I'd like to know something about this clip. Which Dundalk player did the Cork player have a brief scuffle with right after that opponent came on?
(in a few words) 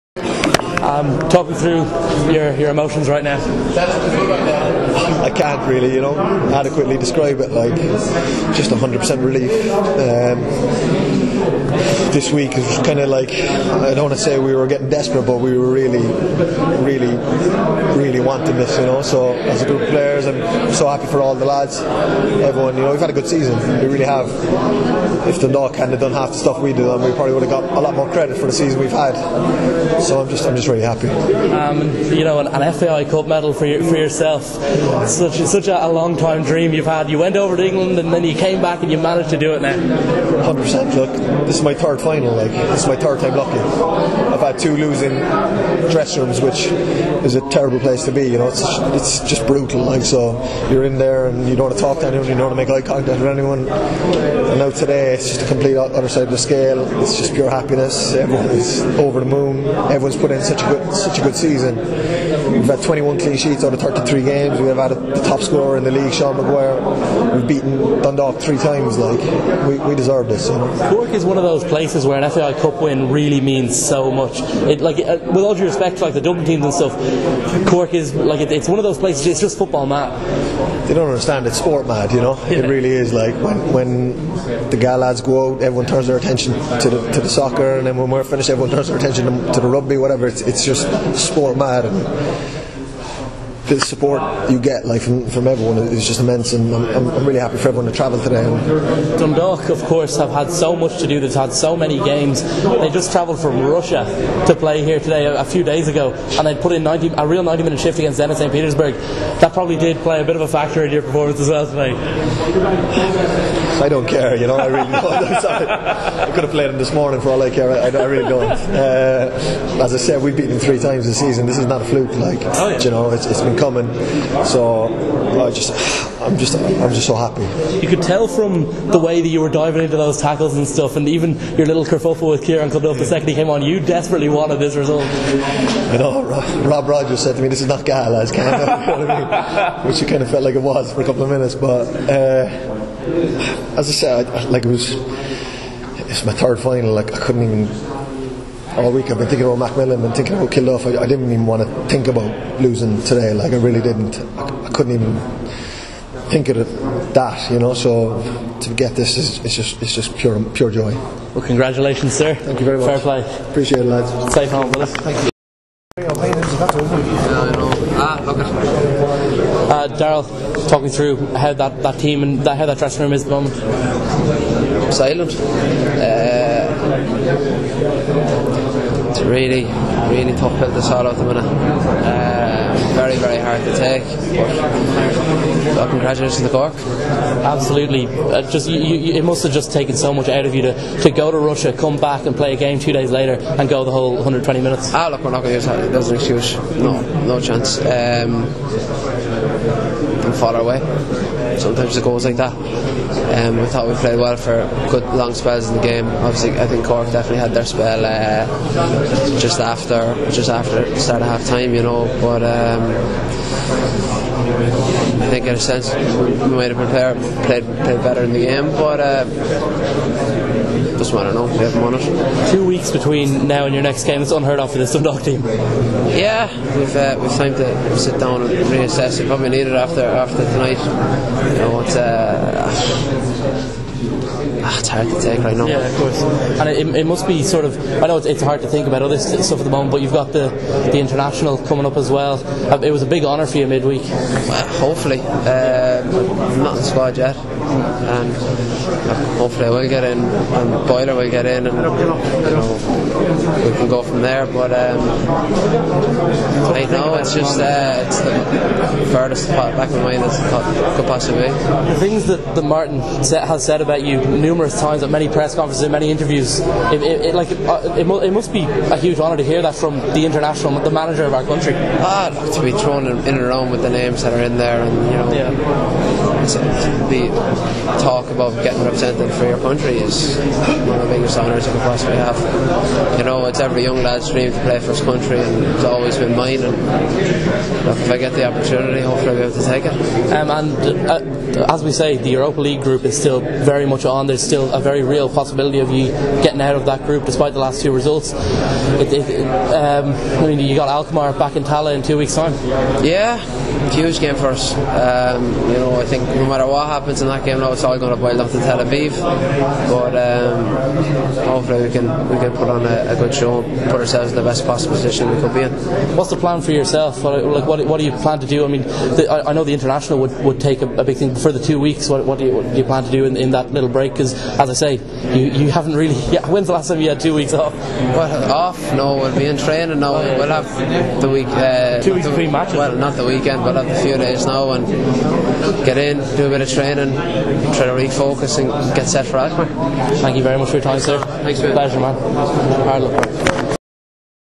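Kieran Kilduff.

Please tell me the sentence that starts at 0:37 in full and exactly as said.
You went over to England and then you came back and you managed to do it now.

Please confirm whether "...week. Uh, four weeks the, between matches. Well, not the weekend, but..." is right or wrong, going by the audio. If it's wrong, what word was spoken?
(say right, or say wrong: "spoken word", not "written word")
wrong: "two", not "four".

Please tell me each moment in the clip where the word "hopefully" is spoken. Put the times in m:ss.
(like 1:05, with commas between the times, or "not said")
4:04, 4:09, 4:48, 5:11.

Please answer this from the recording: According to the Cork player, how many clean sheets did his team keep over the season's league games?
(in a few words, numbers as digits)
21.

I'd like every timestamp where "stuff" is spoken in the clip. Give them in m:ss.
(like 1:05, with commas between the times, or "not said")
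0:26, 1:16, 2:10, 3:59.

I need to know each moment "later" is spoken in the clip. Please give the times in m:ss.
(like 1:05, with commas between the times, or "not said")
3:13.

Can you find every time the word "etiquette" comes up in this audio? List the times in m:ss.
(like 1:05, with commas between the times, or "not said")
not said.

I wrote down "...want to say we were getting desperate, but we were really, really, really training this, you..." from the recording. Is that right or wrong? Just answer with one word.
wrong.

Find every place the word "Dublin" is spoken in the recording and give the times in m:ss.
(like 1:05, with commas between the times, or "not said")
1:16.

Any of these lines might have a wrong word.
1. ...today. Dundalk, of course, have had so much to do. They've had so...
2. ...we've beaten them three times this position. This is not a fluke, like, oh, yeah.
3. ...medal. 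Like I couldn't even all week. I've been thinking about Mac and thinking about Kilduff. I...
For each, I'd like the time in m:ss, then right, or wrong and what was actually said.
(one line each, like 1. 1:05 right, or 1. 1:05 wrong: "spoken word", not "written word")
1. 1:38 right
2. 2:00 wrong: "season", not "position"
3. 2:26 wrong: "final", not "medal".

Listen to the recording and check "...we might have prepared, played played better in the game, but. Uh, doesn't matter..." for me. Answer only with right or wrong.
right.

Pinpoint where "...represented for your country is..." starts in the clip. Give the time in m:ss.
4:38.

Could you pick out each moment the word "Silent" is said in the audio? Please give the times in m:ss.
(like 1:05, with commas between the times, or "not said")
2:54.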